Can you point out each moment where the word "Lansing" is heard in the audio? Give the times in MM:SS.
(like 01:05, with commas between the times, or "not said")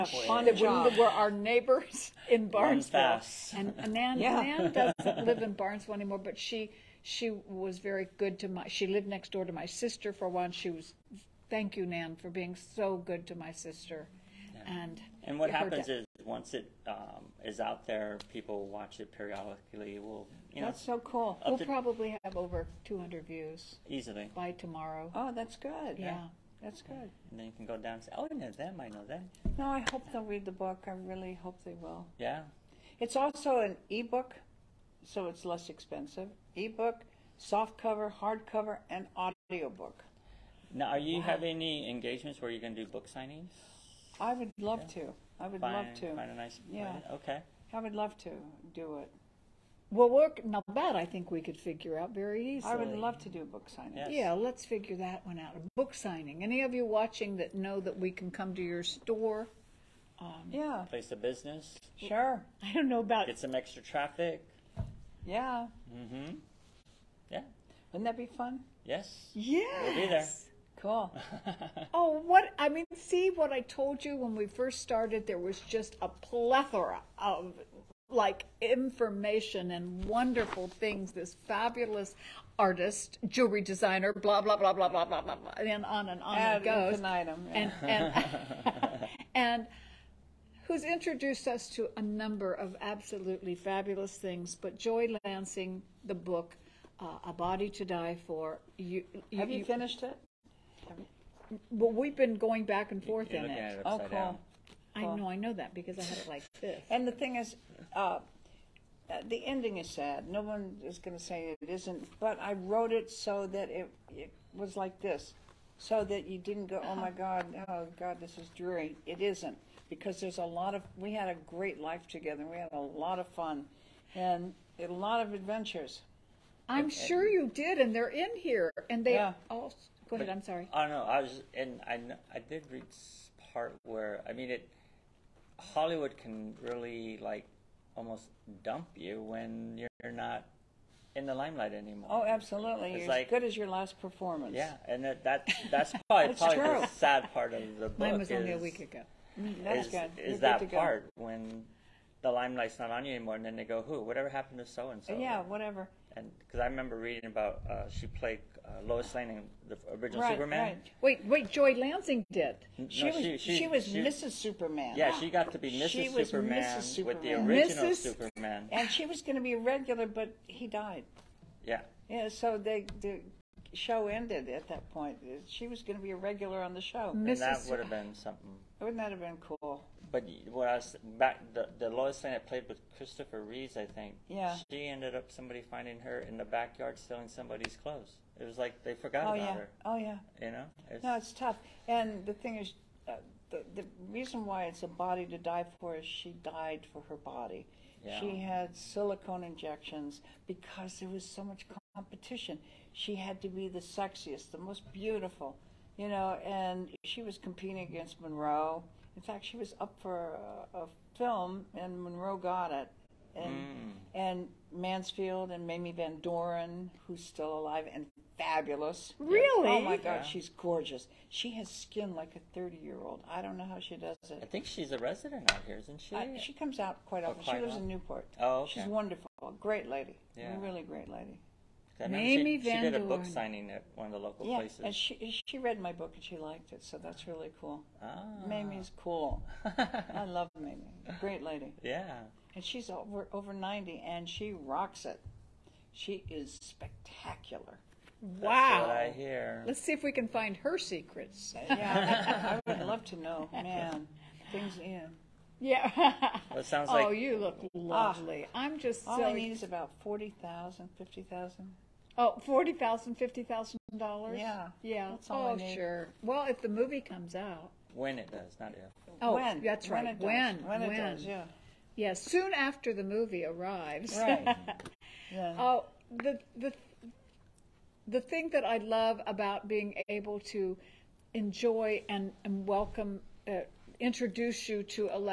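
01:35, 02:41.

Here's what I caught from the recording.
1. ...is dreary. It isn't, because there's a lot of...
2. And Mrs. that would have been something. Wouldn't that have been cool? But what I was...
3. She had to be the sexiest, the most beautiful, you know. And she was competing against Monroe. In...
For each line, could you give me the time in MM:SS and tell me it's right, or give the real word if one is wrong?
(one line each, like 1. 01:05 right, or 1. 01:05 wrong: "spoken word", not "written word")
1. 01:58 right
2. 02:57 right
3. 03:22 right.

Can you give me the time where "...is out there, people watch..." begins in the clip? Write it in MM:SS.
00:17.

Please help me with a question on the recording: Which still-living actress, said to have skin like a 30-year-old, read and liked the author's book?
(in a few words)
Mamie Van Doren.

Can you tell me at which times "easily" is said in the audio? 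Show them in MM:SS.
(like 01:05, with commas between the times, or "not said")
00:23, 00:52.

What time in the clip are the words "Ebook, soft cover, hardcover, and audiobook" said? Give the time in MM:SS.
00:36.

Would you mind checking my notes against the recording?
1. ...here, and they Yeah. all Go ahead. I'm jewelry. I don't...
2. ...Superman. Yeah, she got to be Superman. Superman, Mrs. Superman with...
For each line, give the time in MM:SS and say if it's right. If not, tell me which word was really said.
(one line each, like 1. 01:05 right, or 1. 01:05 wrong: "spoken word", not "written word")
1. 02:08 wrong: "sorry", not "jewelry"
2. 02:44 wrong: "Mrs", not "Superman".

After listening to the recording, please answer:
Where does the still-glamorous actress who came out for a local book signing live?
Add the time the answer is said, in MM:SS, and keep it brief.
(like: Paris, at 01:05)
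Newport, at 03:47.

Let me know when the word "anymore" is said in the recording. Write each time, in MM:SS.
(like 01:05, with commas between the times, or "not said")
00:05, 02:21, 02:33.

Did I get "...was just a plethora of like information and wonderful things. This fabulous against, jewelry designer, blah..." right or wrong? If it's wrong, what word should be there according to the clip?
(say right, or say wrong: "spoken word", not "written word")
wrong: "artist", not "against".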